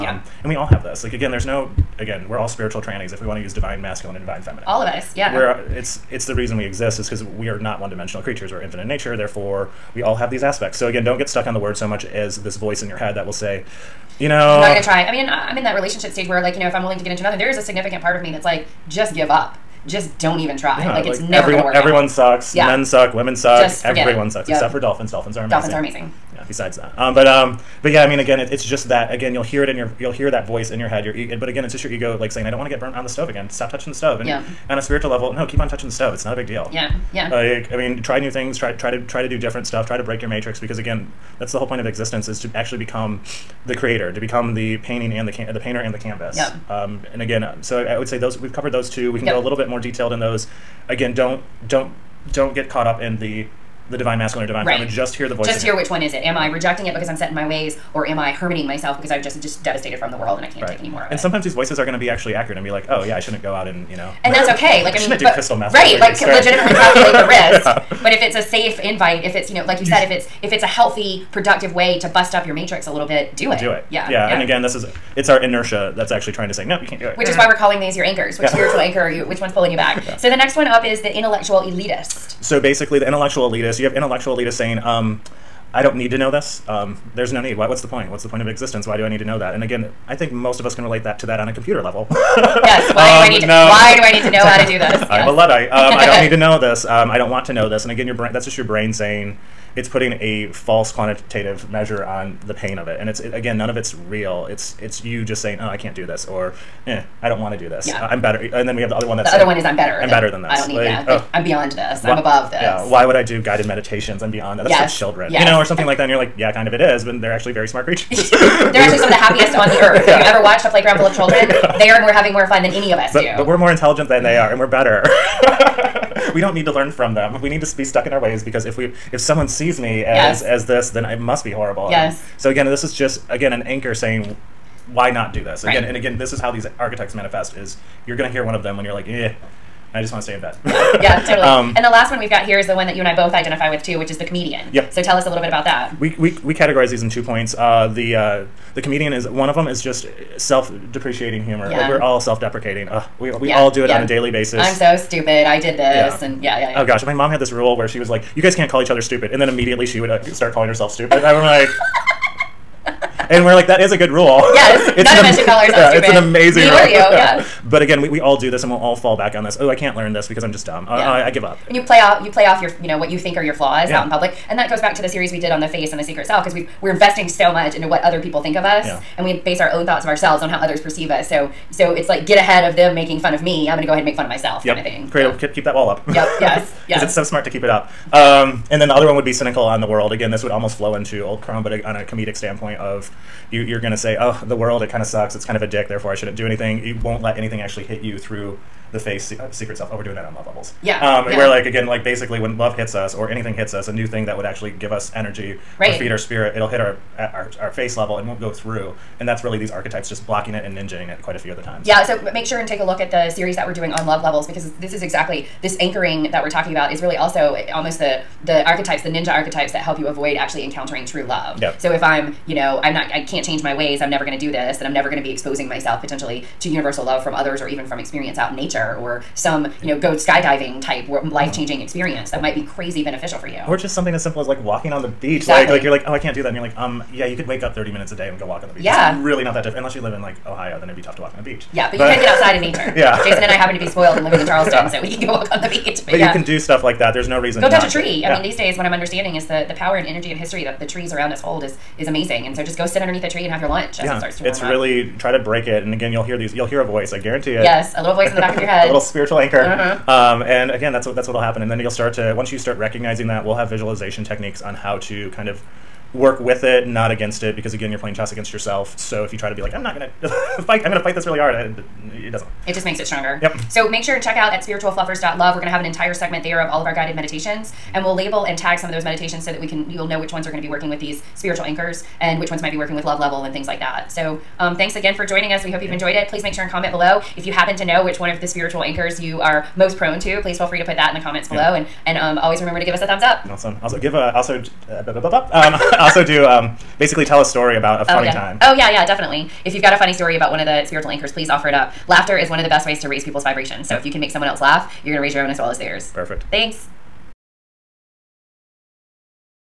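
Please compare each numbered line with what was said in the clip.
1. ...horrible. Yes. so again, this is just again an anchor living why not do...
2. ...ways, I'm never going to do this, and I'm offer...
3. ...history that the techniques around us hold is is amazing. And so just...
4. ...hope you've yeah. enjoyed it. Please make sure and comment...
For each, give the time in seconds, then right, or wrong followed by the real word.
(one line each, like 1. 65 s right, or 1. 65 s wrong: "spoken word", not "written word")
1. 131 s wrong: "saying", not "living"
2. 223 s wrong: "never", not "offer"
3. 250 s wrong: "trees", not "techniques"
4. 285 s right.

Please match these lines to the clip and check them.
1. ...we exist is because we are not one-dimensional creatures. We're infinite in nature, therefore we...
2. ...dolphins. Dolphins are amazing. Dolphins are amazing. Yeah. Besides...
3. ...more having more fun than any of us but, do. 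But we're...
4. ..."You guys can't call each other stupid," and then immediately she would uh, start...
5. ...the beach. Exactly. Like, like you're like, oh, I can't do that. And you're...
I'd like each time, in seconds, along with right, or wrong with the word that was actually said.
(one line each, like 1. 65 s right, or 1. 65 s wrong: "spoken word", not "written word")
1. 6 s right
2. 24 s right
3. 122 s right
4. 158 s right
5. 235 s right.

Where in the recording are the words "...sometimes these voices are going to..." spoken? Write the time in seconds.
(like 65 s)
61 s.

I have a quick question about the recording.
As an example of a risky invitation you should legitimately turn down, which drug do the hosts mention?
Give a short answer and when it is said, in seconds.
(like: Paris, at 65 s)
Crystal meth, at 65 s.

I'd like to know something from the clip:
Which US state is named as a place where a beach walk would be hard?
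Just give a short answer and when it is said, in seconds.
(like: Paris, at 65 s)
Ohio, at 240 s.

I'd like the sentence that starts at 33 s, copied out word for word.
Stop touching the stove." And yeah.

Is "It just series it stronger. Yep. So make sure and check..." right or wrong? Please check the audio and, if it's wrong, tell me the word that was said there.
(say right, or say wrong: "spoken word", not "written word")
wrong: "makes", not "series".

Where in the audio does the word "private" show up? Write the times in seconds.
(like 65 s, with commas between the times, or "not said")
not said.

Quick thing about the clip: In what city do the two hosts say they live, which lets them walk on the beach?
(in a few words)
Charleston.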